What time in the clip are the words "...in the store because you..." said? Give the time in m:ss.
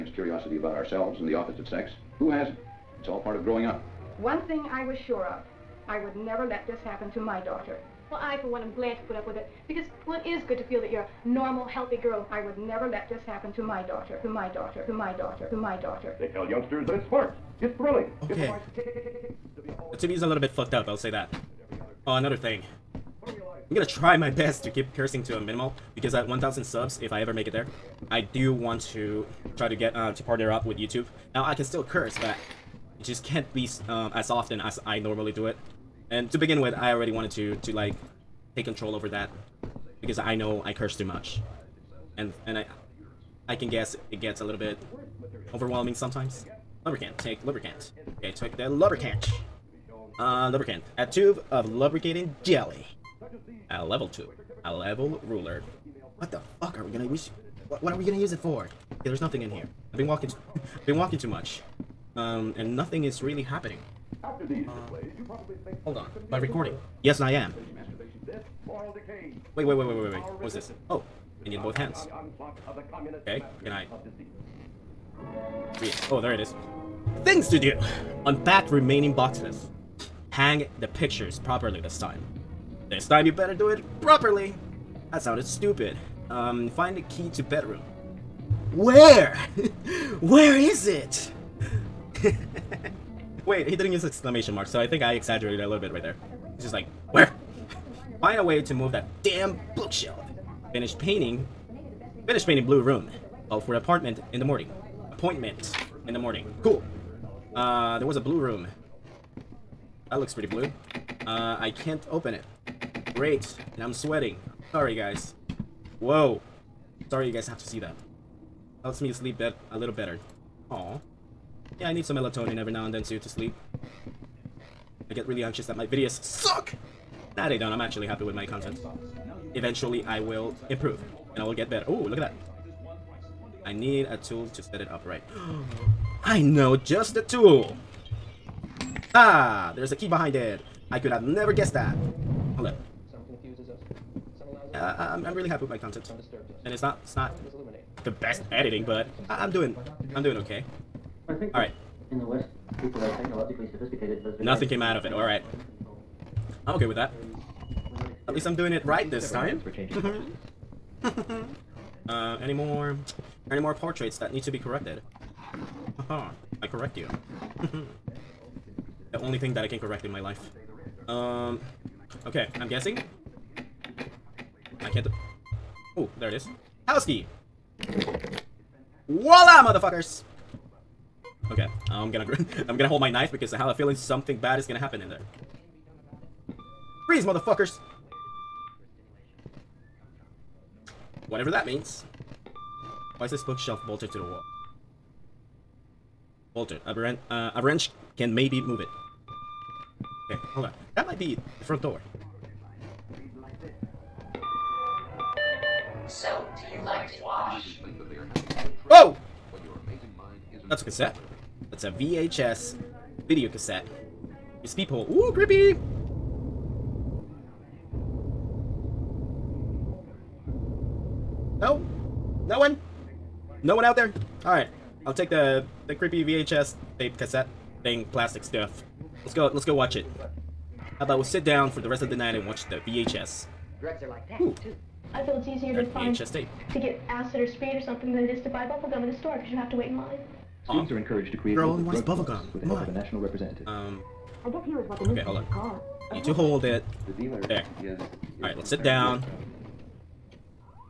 3:59.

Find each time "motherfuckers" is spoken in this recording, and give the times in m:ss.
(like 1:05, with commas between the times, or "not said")
2:59, 3:07.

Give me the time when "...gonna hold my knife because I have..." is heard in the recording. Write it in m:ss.
3:02.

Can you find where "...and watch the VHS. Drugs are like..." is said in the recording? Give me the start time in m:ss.
3:52.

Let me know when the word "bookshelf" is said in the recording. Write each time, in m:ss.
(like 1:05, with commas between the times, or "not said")
1:39, 3:13.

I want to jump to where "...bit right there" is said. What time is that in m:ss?
1:35.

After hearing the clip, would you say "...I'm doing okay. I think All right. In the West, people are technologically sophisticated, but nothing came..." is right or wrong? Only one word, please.
right.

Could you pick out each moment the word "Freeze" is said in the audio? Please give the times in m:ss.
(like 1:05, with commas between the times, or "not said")
3:07.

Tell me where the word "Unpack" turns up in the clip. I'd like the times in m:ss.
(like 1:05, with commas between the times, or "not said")
1:18.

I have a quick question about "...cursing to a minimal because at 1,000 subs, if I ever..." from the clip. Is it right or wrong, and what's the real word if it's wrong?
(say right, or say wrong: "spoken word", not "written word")
right.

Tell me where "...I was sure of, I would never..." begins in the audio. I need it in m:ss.
0:04.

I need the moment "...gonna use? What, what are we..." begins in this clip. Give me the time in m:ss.
0:56.